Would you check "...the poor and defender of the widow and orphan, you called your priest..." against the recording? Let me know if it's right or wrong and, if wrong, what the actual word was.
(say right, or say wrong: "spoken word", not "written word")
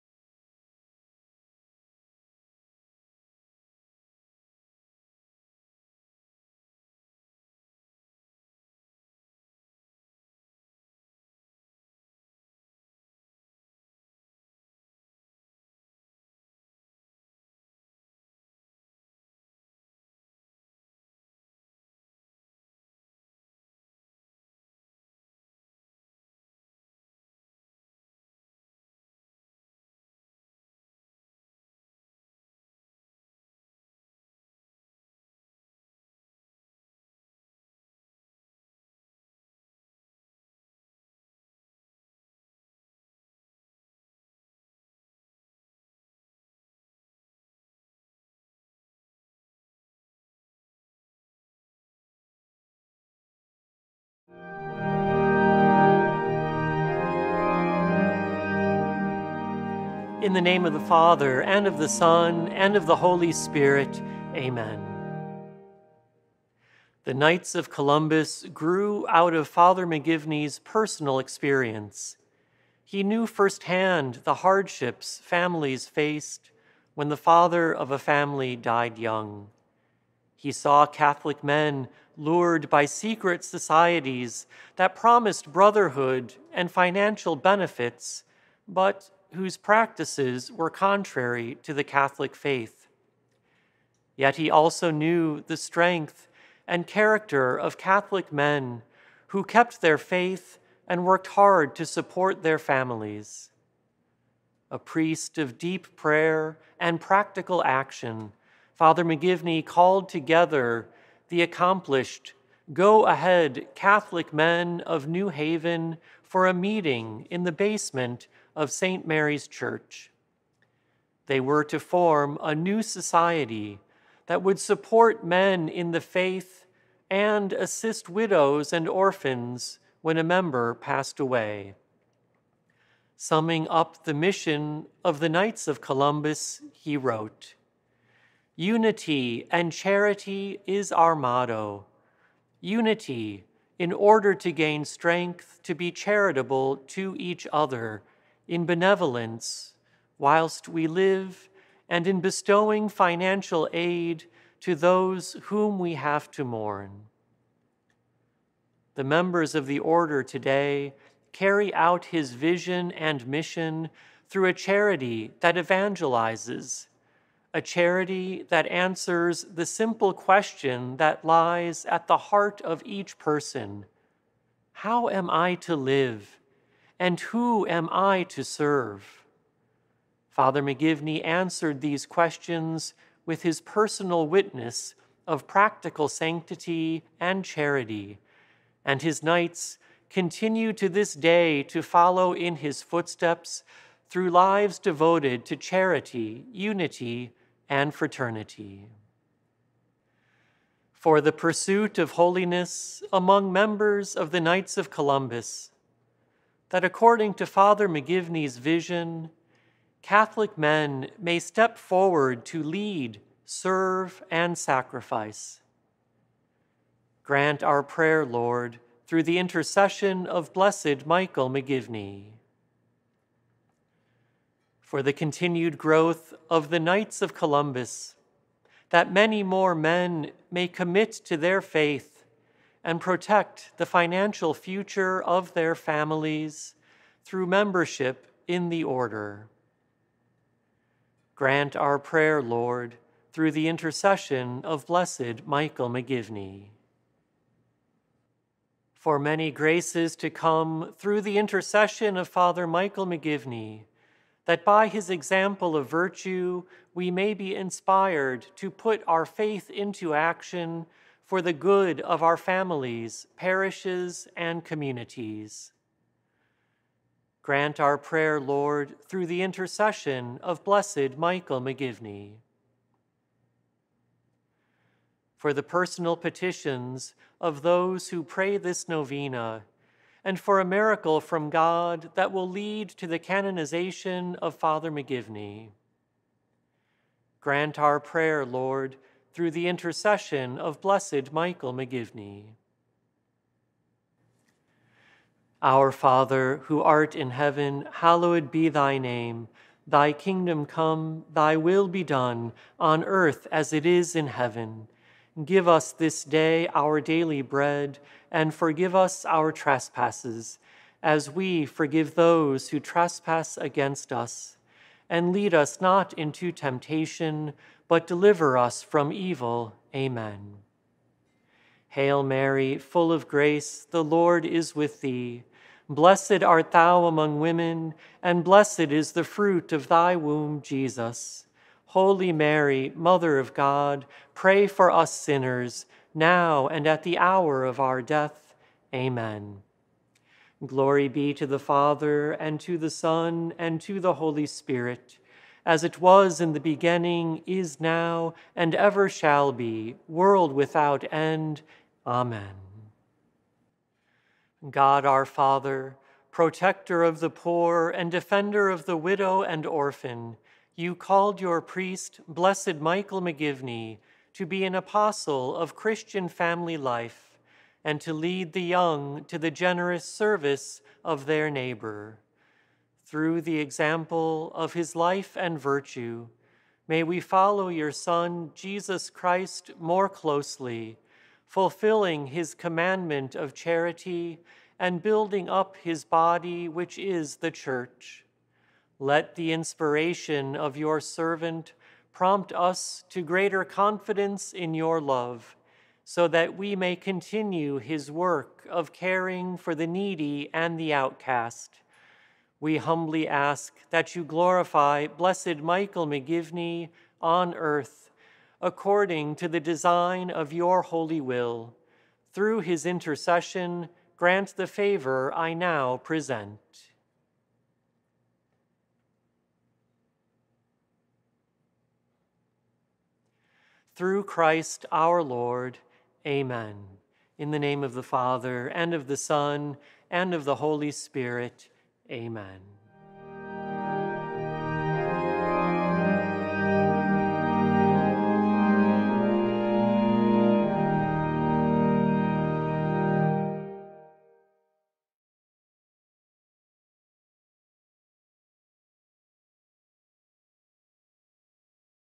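right.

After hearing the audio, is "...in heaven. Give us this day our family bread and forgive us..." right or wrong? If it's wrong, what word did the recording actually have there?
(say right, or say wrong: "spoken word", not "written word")
wrong: "daily", not "family".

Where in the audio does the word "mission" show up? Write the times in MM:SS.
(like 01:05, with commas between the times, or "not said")
02:14, 02:43.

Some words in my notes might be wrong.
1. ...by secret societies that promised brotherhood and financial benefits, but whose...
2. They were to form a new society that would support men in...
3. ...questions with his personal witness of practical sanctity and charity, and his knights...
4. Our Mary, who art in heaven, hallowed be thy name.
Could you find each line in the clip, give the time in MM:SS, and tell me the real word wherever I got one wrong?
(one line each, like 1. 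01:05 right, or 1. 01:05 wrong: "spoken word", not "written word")
1. 01:22 right
2. 02:01 right
3. 03:02 right
4. 04:55 wrong: "Father", not "Mary".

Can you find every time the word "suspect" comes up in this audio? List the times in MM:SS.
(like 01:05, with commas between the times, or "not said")
not said.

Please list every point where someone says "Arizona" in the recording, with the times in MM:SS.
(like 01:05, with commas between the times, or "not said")
not said.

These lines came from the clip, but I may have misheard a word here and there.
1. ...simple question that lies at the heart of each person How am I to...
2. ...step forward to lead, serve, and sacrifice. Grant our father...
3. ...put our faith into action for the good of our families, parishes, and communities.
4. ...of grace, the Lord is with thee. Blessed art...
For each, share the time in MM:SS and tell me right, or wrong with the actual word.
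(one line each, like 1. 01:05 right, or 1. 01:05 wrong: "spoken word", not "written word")
1. 02:49 right
2. 03:31 wrong: "prayer", not "father"
3. 04:18 right
4. 05:23 right.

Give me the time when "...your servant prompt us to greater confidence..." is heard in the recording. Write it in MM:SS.
06:30.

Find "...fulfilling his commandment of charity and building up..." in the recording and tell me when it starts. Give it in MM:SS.
06:21.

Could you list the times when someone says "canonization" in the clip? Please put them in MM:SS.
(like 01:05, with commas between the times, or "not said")
04:43.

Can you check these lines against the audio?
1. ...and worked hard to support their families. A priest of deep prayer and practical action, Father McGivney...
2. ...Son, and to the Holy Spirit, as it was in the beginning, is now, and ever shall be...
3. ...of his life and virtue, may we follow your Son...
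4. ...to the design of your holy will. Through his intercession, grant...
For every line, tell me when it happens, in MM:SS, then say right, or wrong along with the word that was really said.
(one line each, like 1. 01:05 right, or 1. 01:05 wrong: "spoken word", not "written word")
1. 01:40 right
2. 05:42 right
3. 06:14 right
4. 06:49 right.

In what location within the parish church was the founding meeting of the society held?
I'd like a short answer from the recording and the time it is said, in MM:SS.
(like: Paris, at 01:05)
the basement, at 01:57.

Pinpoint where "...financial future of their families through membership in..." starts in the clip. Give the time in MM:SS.
03:53.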